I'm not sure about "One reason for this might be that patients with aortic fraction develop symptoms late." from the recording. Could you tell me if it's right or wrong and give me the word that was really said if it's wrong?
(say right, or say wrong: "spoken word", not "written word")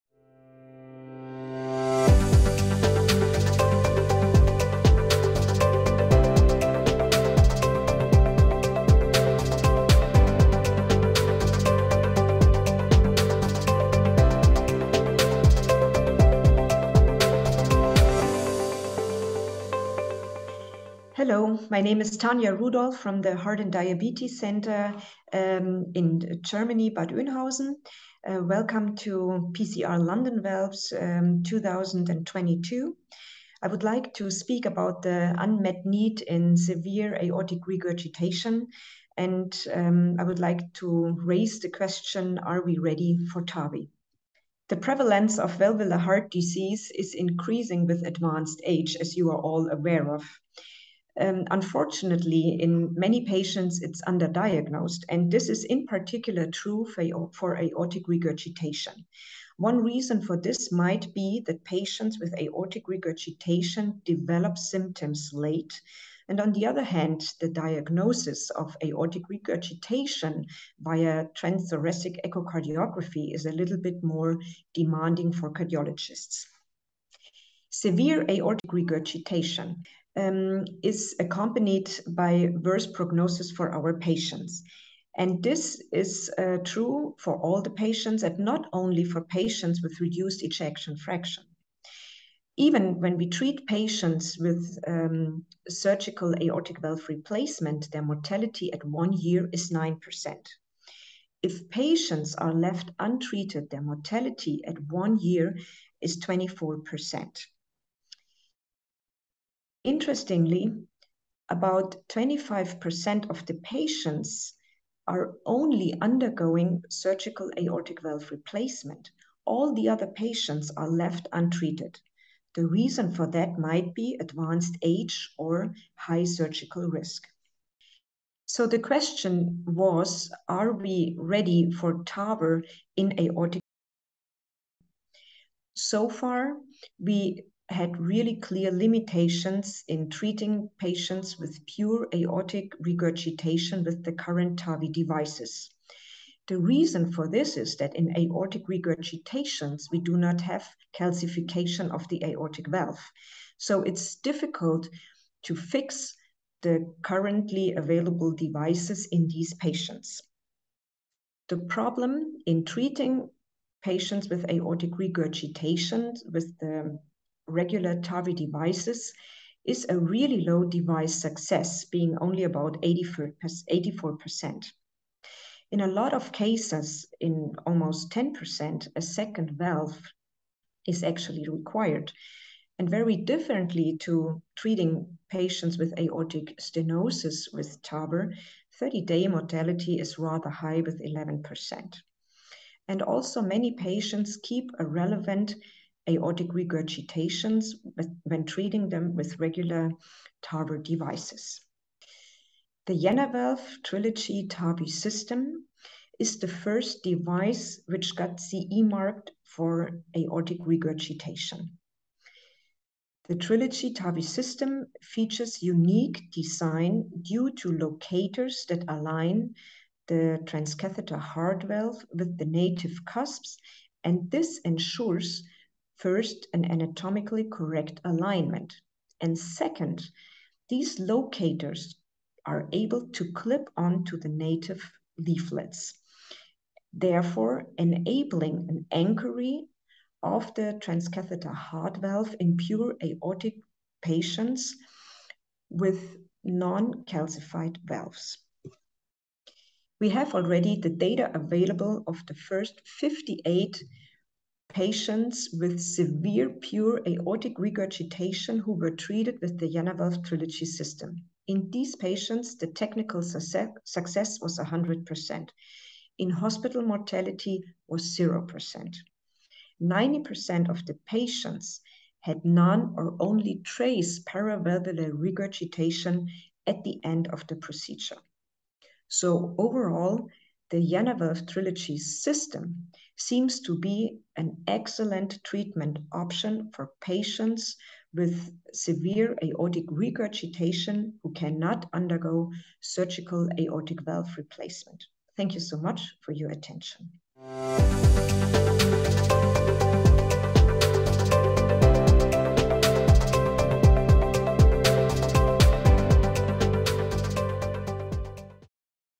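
wrong: "regurgitation", not "fraction".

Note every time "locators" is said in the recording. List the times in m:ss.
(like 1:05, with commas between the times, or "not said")
3:37, 3:50.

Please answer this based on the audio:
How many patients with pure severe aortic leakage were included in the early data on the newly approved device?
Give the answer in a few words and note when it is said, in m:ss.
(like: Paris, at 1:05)
58, at 4:12.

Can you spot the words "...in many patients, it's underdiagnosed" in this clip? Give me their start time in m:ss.
0:52.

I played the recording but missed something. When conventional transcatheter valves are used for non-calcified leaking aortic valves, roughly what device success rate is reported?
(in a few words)
84%.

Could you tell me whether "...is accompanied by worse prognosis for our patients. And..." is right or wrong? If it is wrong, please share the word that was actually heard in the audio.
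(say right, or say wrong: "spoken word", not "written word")
right.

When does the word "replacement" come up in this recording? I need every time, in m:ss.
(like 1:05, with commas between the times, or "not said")
1:37, 1:58, 4:54.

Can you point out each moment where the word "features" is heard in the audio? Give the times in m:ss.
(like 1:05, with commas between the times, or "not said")
3:35.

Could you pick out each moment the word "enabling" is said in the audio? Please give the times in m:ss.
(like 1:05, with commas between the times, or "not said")
3:57.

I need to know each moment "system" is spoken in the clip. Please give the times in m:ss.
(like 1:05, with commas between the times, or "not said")
3:24, 3:34, 4:20, 4:41.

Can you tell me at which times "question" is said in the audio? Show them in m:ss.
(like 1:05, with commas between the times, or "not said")
0:41, 2:08.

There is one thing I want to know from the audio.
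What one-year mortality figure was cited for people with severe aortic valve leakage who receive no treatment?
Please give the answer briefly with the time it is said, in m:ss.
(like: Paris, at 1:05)
24%, at 1:46.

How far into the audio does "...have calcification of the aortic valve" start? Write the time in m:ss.
2:30.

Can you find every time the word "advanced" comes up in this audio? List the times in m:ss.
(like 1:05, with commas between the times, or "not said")
0:48, 2:04.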